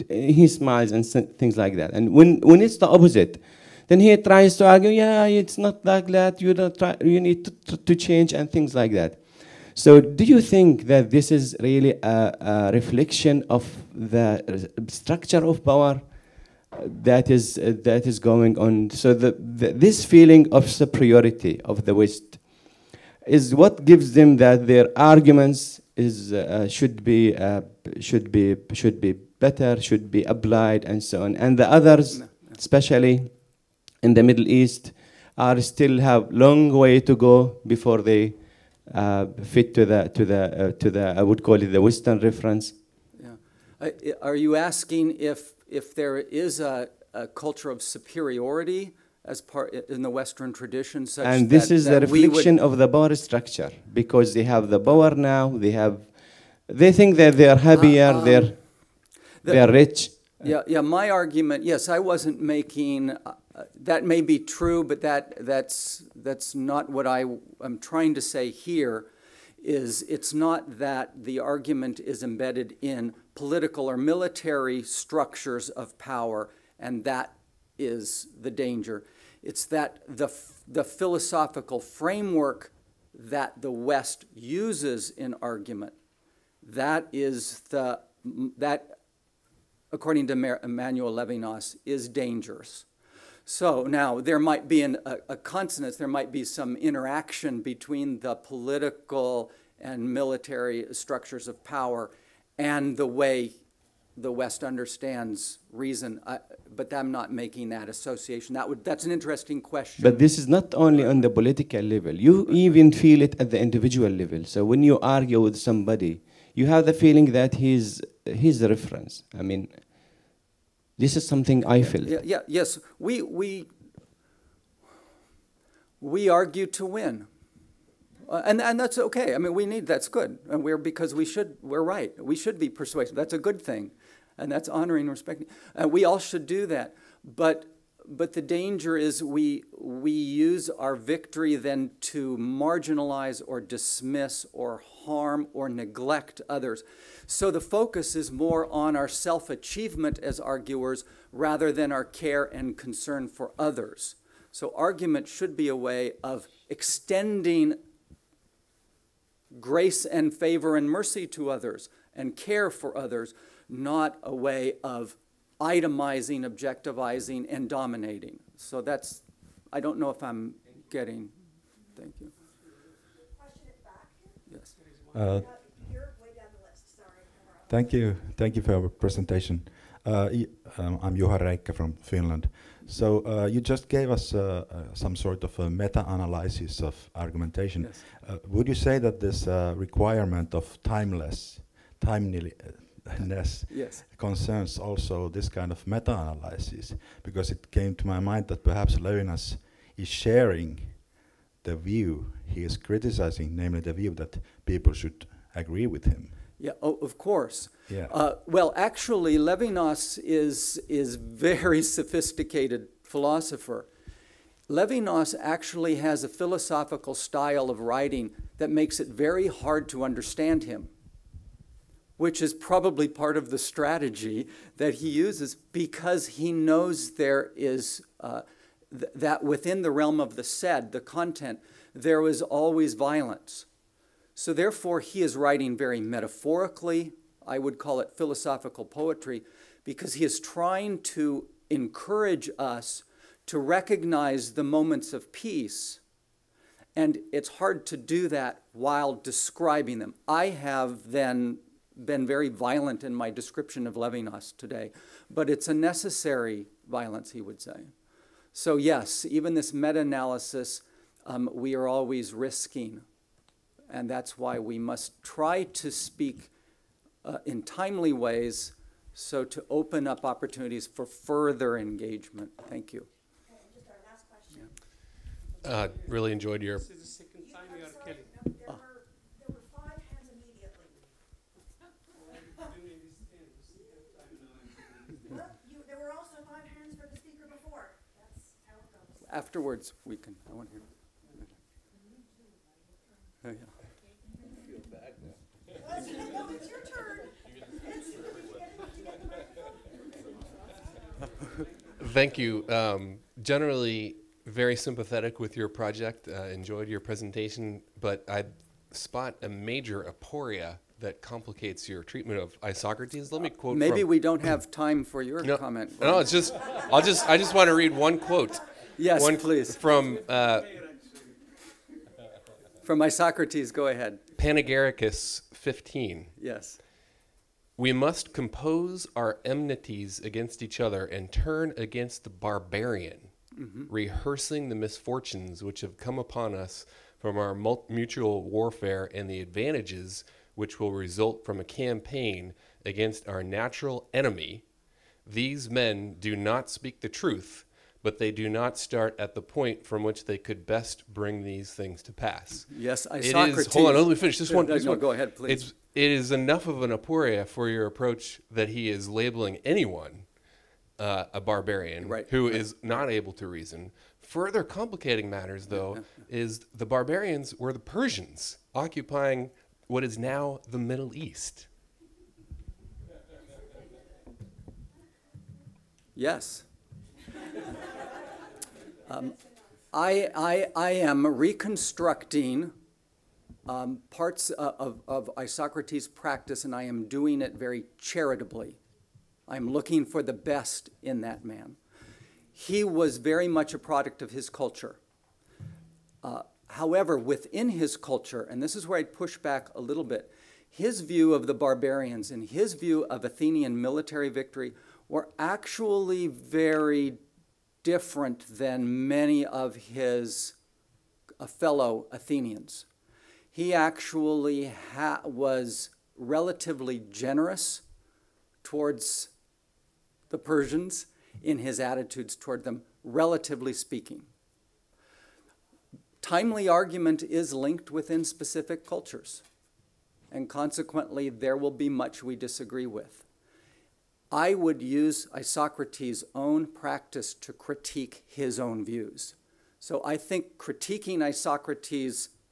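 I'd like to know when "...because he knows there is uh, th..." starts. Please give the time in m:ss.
3:45.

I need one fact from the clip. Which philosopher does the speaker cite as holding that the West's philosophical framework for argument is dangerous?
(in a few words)
Emmanuel Levinas.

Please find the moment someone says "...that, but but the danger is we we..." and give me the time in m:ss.
2:16.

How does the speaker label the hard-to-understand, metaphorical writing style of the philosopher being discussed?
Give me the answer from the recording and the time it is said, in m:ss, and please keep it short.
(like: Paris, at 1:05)
philosophical poetry, at 3:58.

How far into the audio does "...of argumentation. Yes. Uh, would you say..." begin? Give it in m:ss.
3:06.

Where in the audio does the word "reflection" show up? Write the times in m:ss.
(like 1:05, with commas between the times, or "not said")
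0:12, 0:52.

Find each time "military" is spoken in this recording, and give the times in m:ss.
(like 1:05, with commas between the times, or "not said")
1:13, 1:40, 6:43.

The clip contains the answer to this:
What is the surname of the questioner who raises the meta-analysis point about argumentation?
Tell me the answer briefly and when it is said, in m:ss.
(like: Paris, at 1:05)
Reikka, at 3:01.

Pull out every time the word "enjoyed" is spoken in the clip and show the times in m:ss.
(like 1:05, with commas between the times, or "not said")
4:36, 5:06.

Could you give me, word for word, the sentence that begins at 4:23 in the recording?
And that's why we must try to speak uh, in timely ways so to open up opportunities for further engagement.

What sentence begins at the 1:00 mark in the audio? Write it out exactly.
My argument, yes, I wasn't making.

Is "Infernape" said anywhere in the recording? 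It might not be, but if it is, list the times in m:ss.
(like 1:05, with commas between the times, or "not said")
not said.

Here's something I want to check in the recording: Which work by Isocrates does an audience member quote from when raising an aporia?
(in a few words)
Panegyricus.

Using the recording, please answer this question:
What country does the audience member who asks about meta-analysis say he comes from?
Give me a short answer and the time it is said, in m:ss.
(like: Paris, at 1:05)
Finland, at 3:01.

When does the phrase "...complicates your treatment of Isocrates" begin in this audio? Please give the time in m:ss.
5:11.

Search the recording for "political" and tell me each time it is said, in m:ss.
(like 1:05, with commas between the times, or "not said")
1:13, 1:38, 1:51.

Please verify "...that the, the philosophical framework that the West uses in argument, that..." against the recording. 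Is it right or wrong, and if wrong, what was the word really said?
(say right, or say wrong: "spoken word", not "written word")
right.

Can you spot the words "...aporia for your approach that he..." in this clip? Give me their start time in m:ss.
5:56.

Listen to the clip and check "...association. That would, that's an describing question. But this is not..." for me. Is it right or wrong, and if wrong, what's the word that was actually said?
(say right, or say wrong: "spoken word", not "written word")
wrong: "interesting", not "describing".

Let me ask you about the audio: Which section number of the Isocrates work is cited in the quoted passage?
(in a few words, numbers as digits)
15.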